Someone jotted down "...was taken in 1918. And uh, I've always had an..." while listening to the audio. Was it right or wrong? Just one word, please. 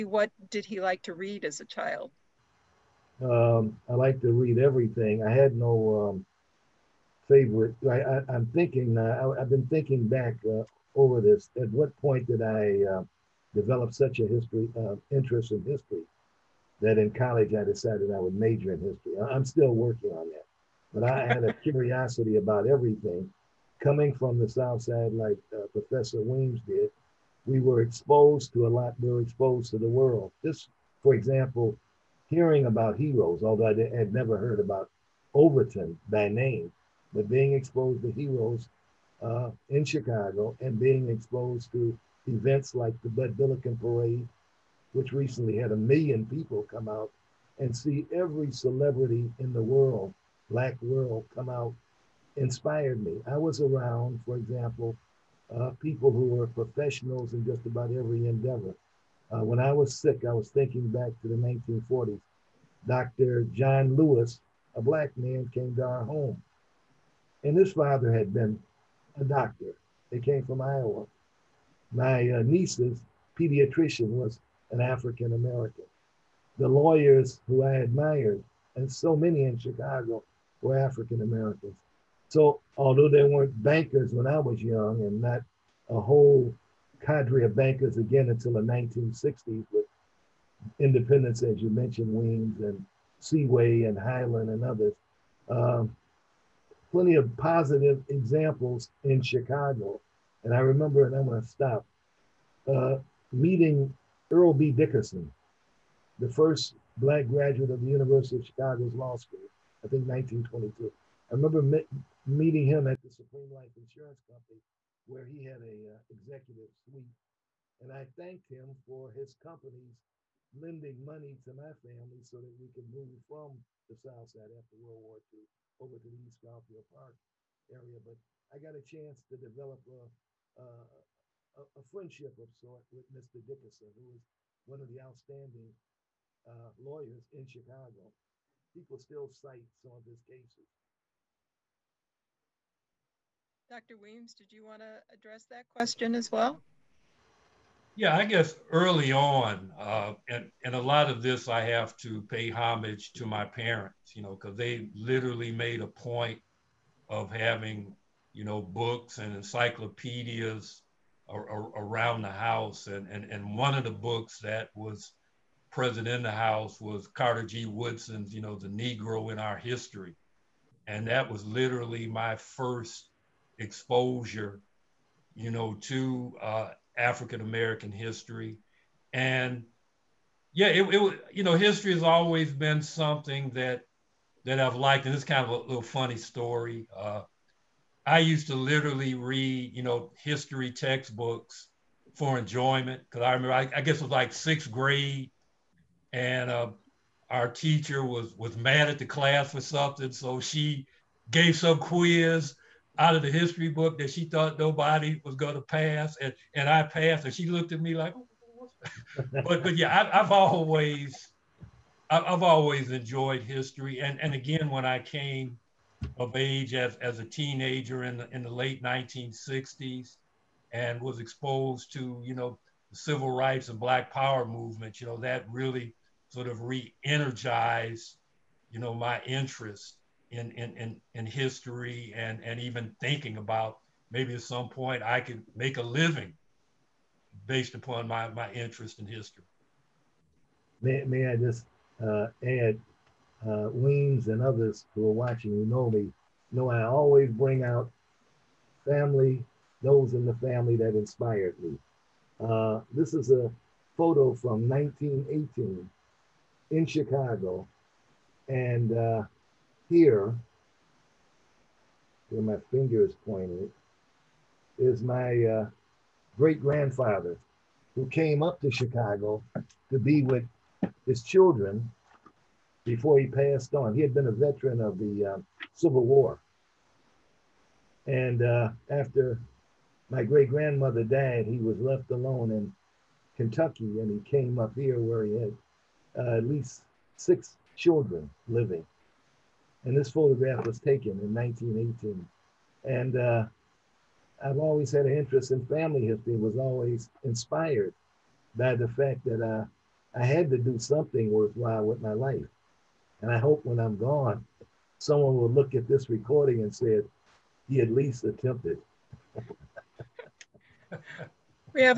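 right.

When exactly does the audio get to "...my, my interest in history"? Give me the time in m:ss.
3:58.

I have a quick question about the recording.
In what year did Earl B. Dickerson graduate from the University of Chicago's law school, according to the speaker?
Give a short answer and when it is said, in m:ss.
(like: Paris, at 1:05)
1922, at 1:50.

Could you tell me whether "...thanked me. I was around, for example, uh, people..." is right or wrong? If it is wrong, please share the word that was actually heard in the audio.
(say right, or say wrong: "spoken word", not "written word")
wrong: "inspired", not "thanked".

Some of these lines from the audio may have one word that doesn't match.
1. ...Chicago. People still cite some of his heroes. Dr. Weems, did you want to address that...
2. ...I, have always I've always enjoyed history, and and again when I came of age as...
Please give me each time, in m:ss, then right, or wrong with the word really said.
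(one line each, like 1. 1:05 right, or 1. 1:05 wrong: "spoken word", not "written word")
1. 2:17 wrong: "cases", not "heroes"
2. 3:30 right.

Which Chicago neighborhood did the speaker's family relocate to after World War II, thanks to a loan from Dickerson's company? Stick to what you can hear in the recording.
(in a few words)
East Garfield Park.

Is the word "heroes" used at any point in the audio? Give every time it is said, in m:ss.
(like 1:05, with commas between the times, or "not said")
0:32, 0:38.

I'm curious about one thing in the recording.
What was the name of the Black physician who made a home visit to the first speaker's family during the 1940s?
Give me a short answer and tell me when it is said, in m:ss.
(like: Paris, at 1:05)
Dr. John Lewis, at 1:02.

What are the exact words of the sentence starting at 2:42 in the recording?
And, and, and one of the books that was present in the house was Carter G.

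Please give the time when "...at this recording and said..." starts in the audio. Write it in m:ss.
5:05.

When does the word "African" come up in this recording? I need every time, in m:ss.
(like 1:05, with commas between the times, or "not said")
1:14, 1:20, 2:56.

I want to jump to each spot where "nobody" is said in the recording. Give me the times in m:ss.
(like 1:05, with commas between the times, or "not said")
3:24.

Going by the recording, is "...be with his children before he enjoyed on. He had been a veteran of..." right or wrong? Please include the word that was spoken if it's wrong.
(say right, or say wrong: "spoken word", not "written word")
wrong: "passed", not "enjoyed".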